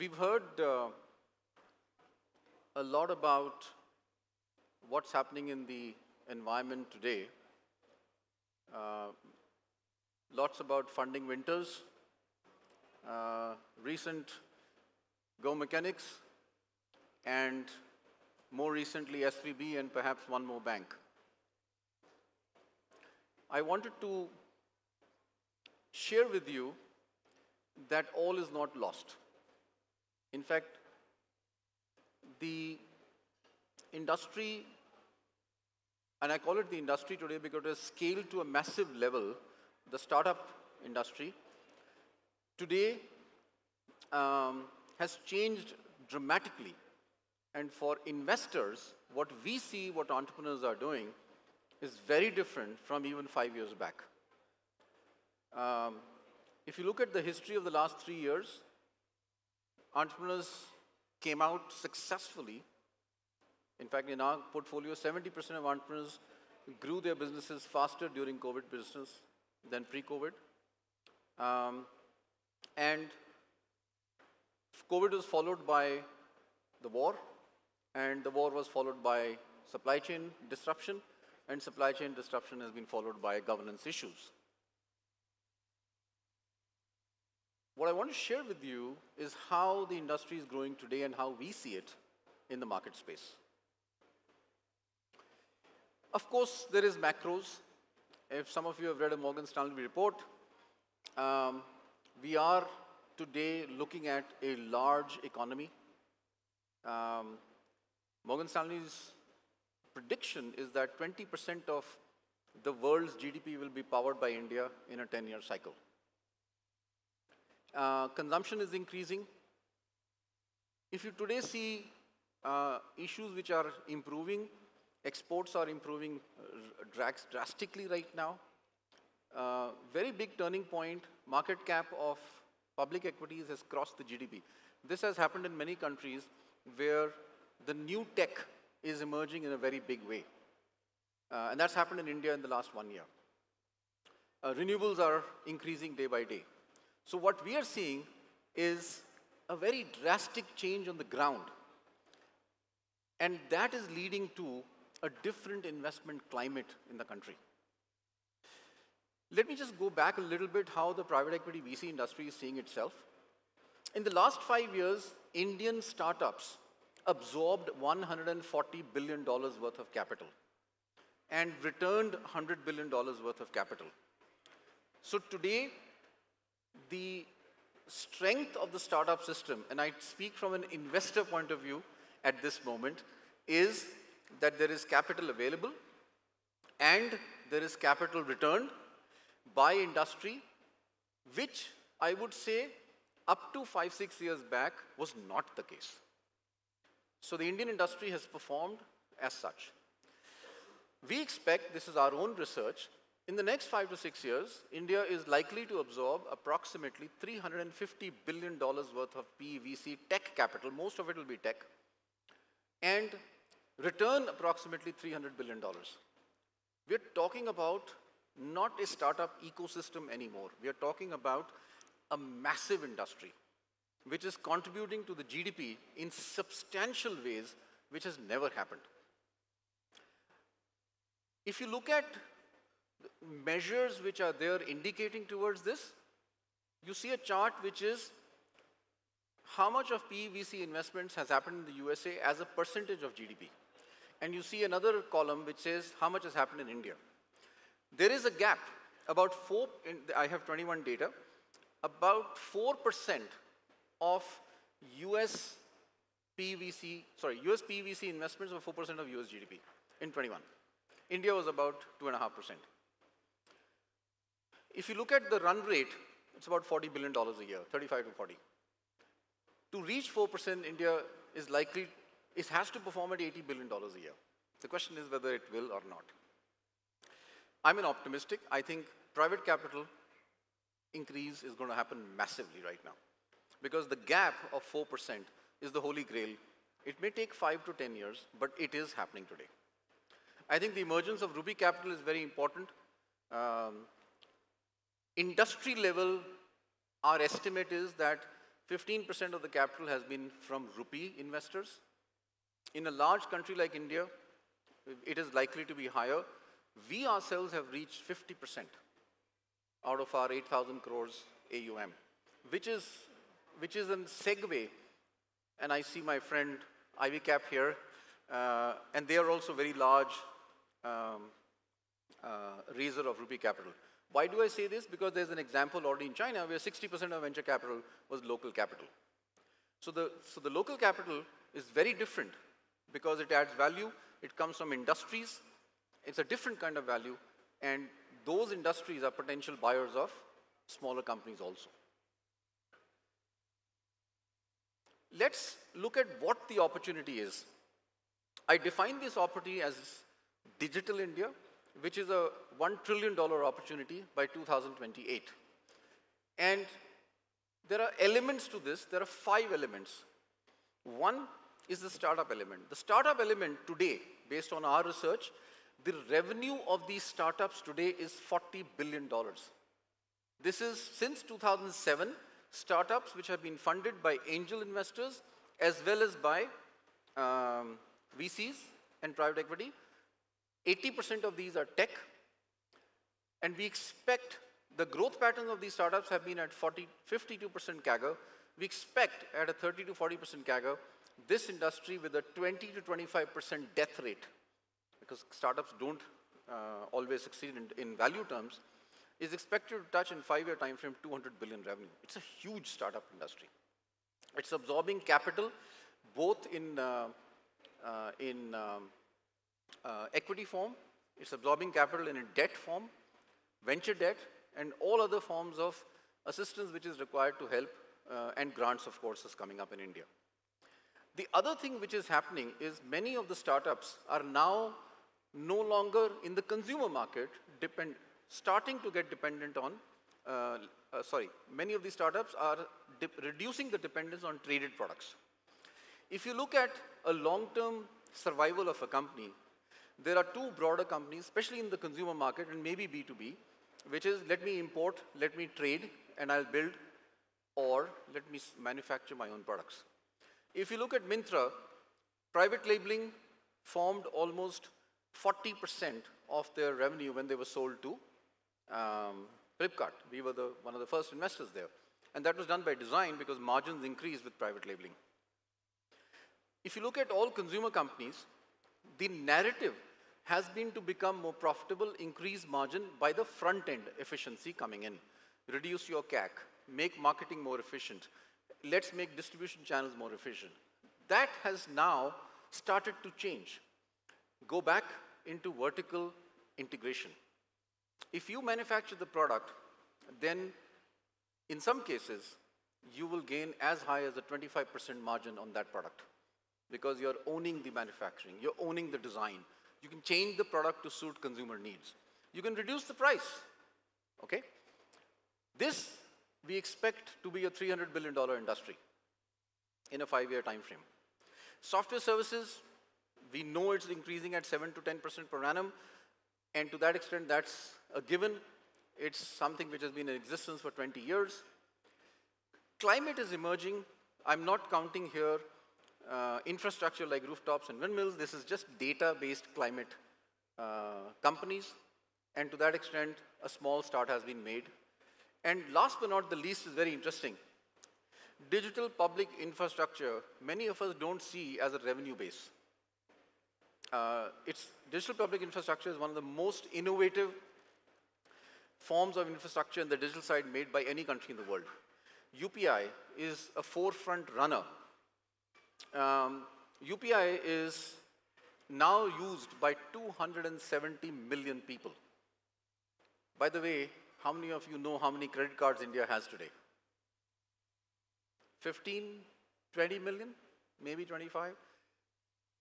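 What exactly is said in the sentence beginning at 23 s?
I wanted to share with you that all is not lost.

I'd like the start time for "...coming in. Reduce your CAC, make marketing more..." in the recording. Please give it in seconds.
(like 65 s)
474 s.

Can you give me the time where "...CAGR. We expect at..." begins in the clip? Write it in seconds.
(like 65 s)
387 s.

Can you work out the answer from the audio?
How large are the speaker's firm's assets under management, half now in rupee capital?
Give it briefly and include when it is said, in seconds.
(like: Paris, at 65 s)
8,000 crores, at 310 s.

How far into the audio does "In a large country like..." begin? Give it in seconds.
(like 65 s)
302 s.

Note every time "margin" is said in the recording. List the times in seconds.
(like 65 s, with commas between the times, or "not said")
463 s, 472 s, 495 s.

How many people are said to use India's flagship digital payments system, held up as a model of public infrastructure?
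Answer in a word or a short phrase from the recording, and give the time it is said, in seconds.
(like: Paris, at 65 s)
270 million, at 559 s.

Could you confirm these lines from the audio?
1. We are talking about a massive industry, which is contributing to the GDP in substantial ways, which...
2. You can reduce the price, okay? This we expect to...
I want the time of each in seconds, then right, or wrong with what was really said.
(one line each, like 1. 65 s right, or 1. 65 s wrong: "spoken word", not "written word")
1. 220 s right
2. 502 s right.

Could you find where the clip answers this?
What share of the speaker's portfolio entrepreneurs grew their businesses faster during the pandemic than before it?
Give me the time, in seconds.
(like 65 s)
64 s.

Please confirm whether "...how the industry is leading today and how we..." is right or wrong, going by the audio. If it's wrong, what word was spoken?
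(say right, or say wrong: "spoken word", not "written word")
wrong: "growing", not "leading".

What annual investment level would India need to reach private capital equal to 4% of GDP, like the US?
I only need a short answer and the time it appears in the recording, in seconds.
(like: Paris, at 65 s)
$80 billion, at 273 s.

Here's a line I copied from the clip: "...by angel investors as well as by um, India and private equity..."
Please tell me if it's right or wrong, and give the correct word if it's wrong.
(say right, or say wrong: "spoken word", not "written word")
wrong: "VCs", not "India".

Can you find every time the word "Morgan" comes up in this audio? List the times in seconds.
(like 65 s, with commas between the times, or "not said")
99 s, 108 s.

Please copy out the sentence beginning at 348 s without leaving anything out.
I define this opportunity as digital India which is a $1 trillion opportunity by 2028.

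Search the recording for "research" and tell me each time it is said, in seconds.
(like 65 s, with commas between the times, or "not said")
202 s, 364 s.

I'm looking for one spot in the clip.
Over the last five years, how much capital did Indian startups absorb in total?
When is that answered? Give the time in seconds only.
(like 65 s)
167 s.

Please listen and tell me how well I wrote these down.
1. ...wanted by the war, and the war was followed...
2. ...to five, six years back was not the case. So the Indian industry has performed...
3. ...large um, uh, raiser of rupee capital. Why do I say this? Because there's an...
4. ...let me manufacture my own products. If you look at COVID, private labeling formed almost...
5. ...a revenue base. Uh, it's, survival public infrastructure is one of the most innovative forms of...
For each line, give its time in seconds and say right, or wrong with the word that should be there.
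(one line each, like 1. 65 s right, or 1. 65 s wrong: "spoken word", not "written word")
1. 75 s wrong: "followed", not "wanted"
2. 193 s right
3. 319 s right
4. 448 s wrong: "Myntra", not "COVID"
5. 541 s wrong: "digital", not "survival".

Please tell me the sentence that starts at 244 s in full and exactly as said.
And you see another column which says how much has happened in India.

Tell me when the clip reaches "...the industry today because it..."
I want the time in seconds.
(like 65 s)
36 s.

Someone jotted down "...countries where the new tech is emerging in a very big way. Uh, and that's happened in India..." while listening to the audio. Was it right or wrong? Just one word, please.
right.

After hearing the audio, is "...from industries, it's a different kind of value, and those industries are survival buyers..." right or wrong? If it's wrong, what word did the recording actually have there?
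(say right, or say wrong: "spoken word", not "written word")
wrong: "potential", not "survival".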